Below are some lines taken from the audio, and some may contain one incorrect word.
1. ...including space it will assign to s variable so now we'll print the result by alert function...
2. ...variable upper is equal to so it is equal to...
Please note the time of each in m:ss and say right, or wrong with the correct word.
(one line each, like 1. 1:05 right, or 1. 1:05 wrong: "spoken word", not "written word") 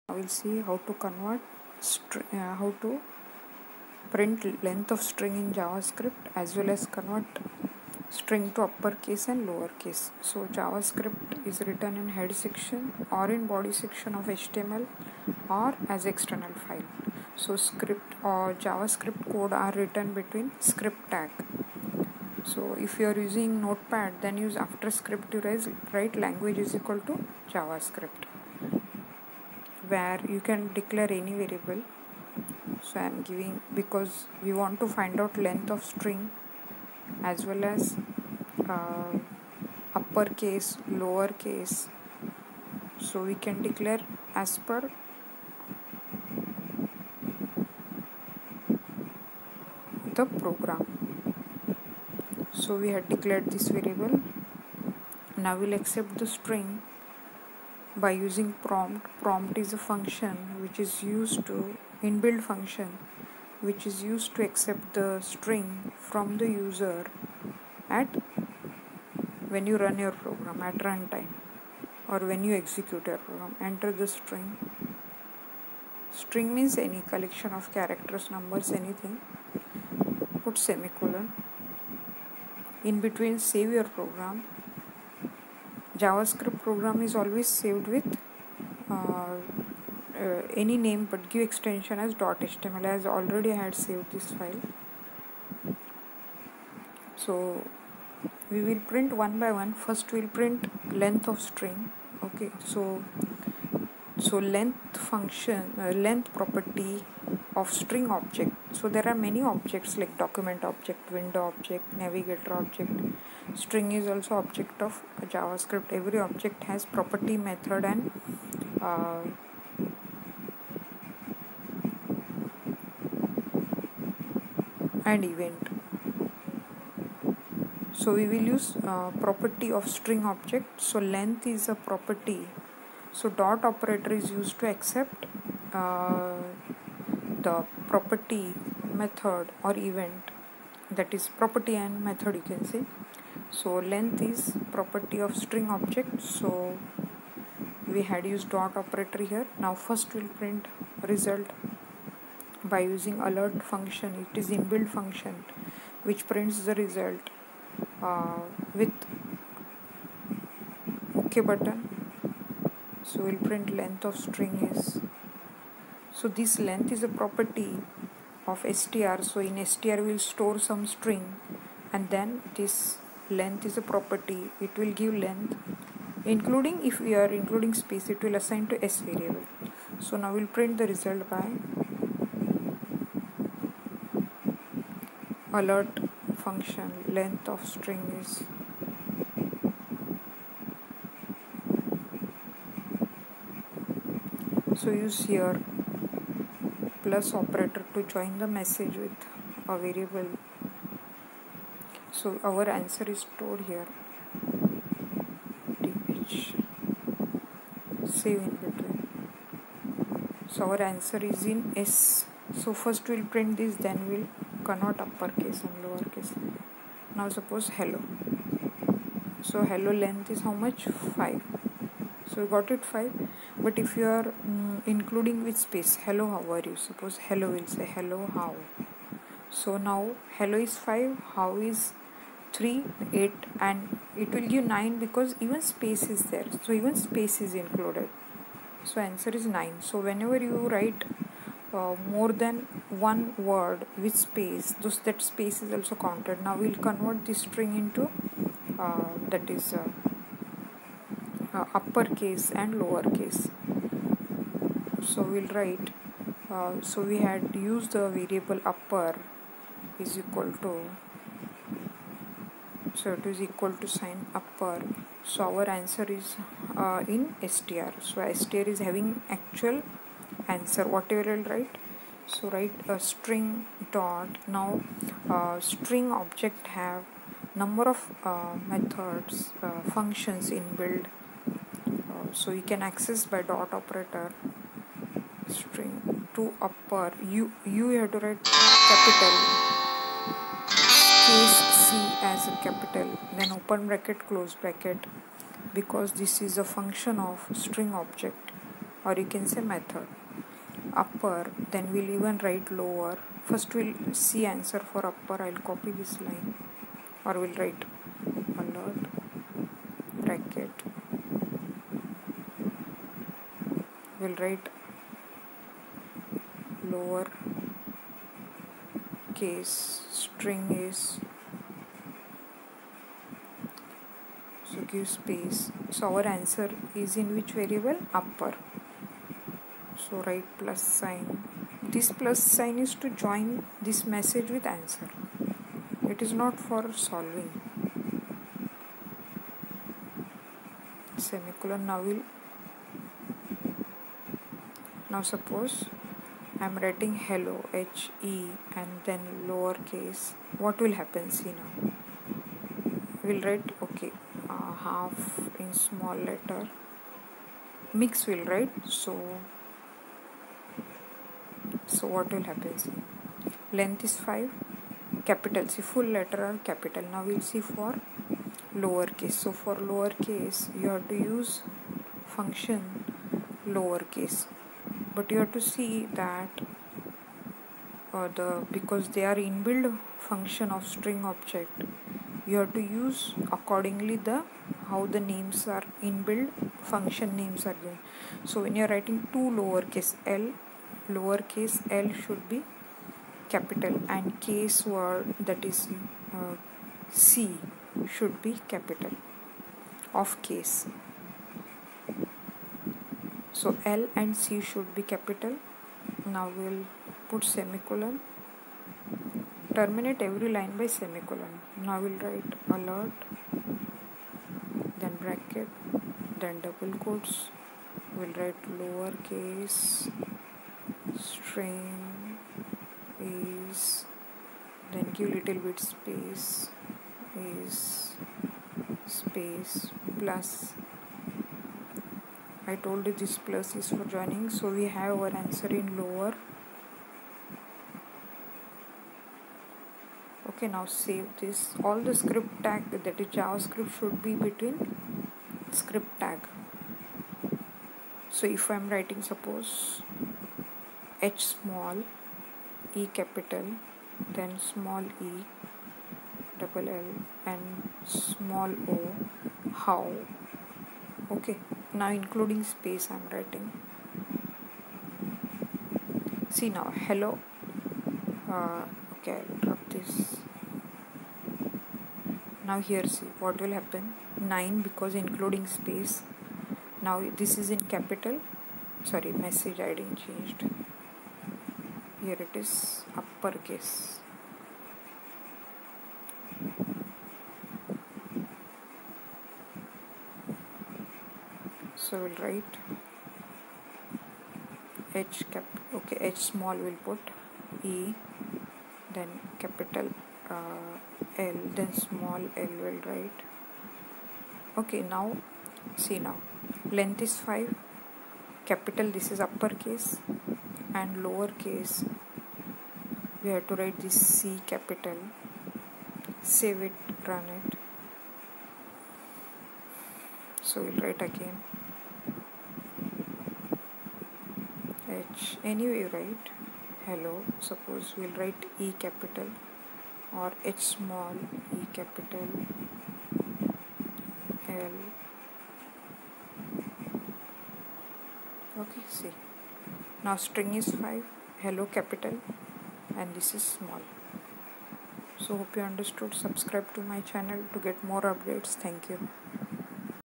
1. 2:57 right
2. 4:18 right.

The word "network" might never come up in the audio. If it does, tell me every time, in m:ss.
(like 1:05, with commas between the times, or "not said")
not said.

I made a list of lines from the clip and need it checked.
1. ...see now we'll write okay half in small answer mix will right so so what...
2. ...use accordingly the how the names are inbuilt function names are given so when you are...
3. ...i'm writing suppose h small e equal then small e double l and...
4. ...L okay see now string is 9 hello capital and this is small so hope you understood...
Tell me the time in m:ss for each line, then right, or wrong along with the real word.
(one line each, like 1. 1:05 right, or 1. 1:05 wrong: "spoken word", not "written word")
1. 5:51 wrong: "letter", not "answer"
2. 6:22 right
3. 7:28 wrong: "capital", not "equal"
4. 8:54 wrong: "5", not "9".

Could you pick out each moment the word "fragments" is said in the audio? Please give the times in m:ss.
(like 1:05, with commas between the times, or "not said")
not said.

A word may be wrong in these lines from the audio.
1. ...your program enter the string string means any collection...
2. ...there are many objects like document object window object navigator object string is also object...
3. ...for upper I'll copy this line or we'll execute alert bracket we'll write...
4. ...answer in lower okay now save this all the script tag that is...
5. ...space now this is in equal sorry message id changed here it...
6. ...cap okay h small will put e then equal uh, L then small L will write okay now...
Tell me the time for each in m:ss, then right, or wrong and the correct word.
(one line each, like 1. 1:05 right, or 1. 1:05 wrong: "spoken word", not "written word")
1. 1:13 right
2. 1:48 right
3. 5:04 wrong: "write", not "execute"
4. 7:15 right
5. 7:55 wrong: "capital", not "equal"
6. 8:15 wrong: "capital", not "equal".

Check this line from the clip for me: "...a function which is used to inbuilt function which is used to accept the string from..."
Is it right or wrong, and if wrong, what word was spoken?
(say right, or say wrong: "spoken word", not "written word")
right.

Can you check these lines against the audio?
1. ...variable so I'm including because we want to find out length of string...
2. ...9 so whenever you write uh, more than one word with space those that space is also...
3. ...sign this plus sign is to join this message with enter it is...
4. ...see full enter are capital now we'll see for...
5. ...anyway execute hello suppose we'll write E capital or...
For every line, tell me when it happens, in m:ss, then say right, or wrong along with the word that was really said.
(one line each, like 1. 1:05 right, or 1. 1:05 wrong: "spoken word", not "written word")
1. 0:31 wrong: "giving", not "including"
2. 3:59 right
3. 5:30 wrong: "answer", not "enter"
4. 6:05 wrong: "letter", not "enter"
5. 8:45 wrong: "write", not "execute".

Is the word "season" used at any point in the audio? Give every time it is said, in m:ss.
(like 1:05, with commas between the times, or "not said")
not said.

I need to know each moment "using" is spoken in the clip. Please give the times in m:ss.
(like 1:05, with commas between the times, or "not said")
0:23, 0:58, 2:32.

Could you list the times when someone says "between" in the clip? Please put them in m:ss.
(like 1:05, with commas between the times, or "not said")
0:20, 1:23, 3:28, 7:24.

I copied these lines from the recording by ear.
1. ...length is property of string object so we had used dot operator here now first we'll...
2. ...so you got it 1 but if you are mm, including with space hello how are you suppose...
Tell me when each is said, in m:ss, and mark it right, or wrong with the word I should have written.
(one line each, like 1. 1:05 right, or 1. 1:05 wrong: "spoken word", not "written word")
1. 2:23 right
2. 3:42 wrong: "5", not "1".